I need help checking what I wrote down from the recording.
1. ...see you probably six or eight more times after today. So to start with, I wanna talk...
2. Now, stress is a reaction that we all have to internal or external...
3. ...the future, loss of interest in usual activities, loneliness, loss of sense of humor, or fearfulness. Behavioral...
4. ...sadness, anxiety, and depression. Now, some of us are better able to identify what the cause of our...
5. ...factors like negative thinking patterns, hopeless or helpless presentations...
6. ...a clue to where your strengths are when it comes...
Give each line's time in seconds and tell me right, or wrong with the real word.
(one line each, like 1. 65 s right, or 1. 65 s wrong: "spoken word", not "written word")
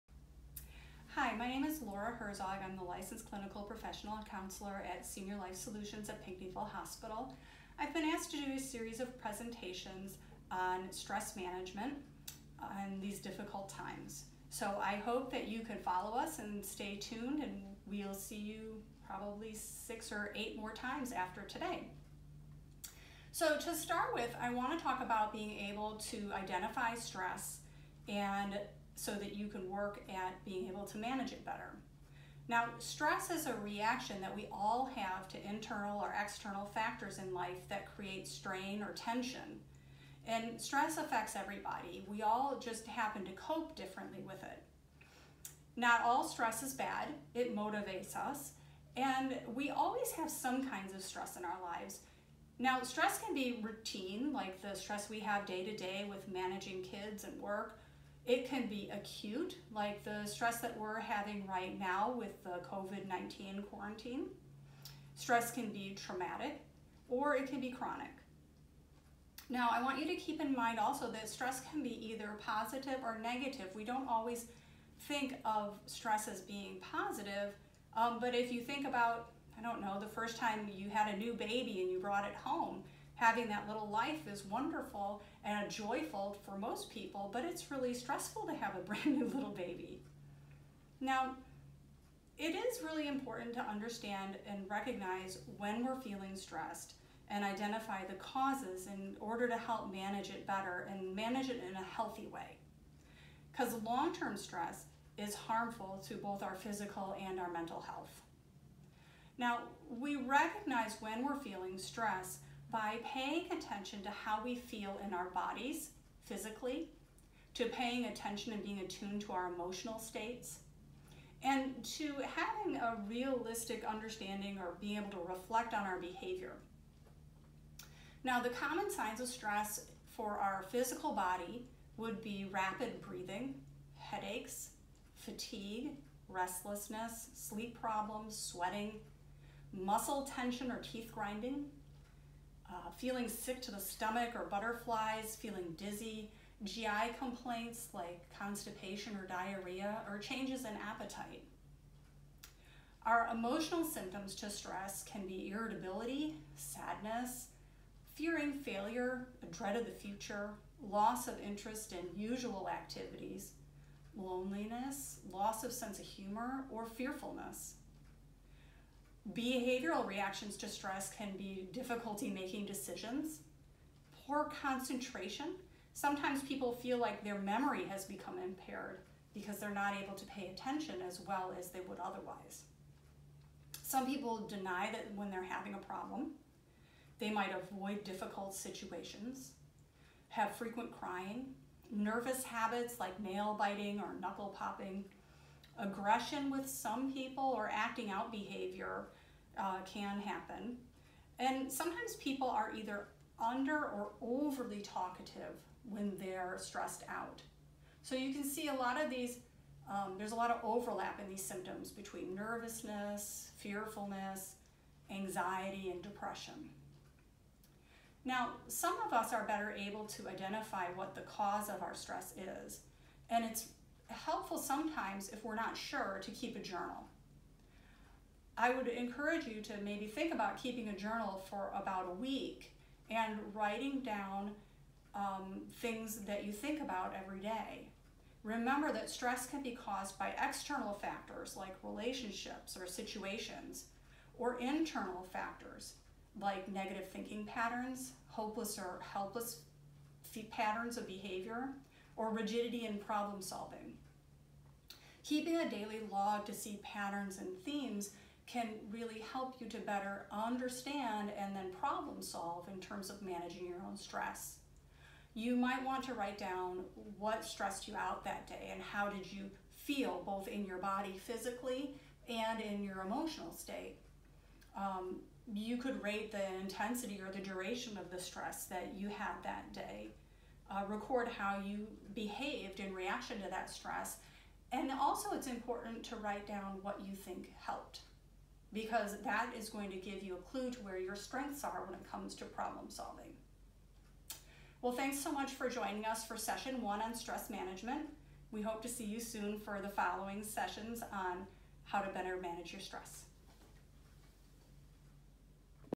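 1. 18 s right
2. 32 s right
3. 159 s right
4. 213 s wrong: "fearfulness", not "sadness"
5. 245 s wrong: "patterns", not "presentations"
6. 290 s right.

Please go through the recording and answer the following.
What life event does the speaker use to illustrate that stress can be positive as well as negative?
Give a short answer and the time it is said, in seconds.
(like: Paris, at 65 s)
new baby, at 81 s.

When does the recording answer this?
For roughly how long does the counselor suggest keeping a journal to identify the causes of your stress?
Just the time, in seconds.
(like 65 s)
231 s.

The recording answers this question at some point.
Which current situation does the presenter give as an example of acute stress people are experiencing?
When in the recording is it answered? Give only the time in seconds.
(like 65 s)
62 s.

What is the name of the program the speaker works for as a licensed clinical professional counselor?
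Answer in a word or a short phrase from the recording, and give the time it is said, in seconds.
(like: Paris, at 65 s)
Senior Life Solutions, at 5 s.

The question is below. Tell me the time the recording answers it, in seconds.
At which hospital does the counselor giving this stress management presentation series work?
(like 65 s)
6 s.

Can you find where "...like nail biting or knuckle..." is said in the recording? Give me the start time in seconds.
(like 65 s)
192 s.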